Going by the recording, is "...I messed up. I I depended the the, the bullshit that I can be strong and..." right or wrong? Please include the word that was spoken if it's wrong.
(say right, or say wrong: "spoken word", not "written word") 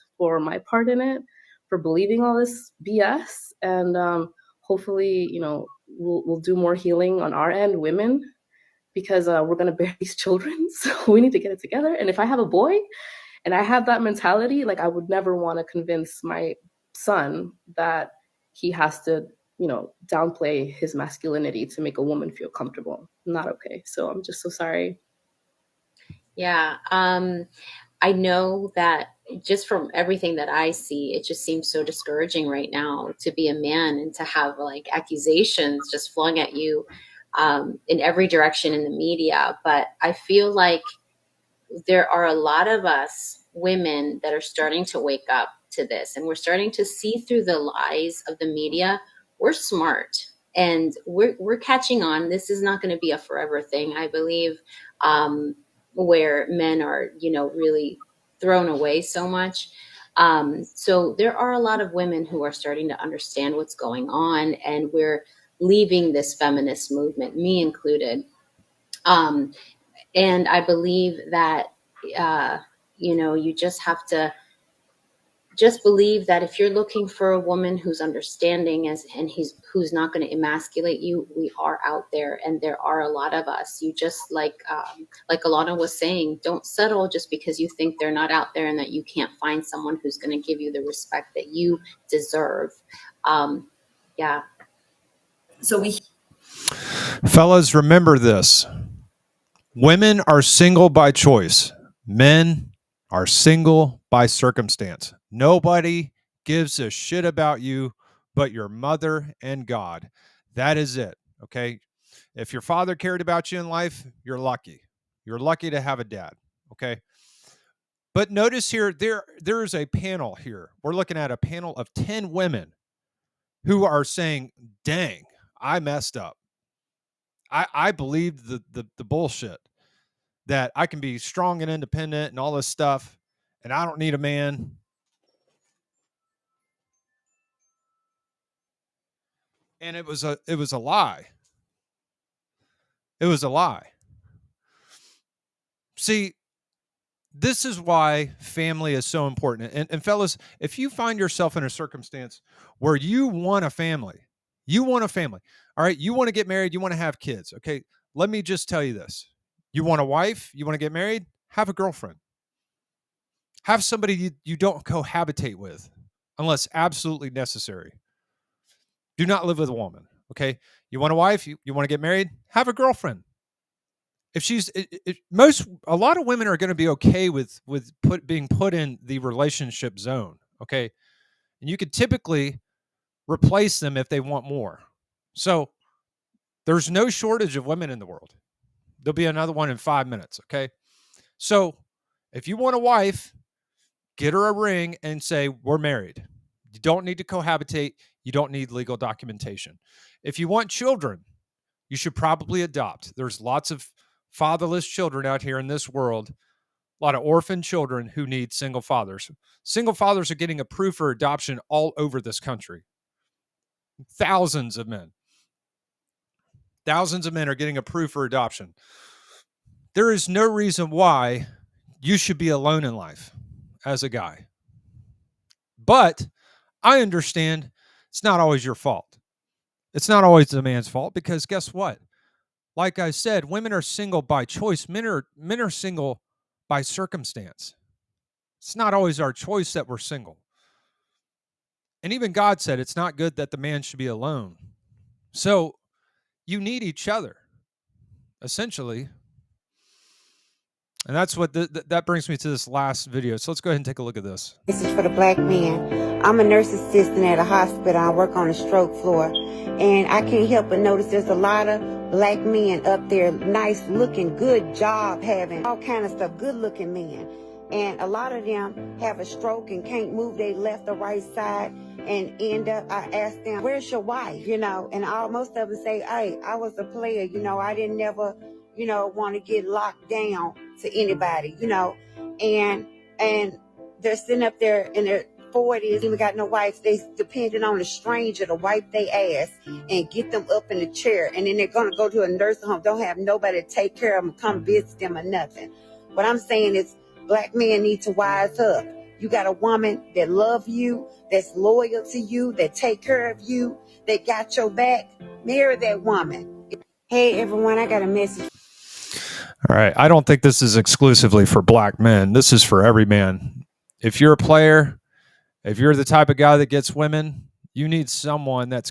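wrong: "believed", not "depended".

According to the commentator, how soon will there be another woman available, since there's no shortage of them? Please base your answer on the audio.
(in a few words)
5 minutes.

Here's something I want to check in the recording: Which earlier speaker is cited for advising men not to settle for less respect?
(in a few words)
Alana.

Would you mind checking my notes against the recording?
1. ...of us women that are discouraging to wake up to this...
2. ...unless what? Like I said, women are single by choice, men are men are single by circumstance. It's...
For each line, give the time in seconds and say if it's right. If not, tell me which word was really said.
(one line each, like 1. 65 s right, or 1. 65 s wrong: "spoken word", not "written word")
1. 42 s wrong: "starting", not "discouraging"
2. 231 s wrong: "guess", not "unless".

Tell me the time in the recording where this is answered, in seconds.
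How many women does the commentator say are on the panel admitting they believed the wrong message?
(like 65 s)
121 s.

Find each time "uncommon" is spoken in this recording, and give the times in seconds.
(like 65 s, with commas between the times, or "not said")
not said.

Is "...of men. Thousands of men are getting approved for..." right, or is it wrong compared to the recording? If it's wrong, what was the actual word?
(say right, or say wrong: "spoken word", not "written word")
right.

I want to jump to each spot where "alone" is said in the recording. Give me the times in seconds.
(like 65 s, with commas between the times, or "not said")
222 s, 244 s.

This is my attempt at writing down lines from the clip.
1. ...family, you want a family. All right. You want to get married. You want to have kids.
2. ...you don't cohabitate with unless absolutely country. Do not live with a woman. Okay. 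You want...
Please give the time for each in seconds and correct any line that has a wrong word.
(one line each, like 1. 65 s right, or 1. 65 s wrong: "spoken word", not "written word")
1. 153 s right
2. 164 s wrong: "necessary", not "country".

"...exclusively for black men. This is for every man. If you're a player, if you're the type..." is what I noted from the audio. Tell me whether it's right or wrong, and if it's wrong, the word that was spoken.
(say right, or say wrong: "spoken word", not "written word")
right.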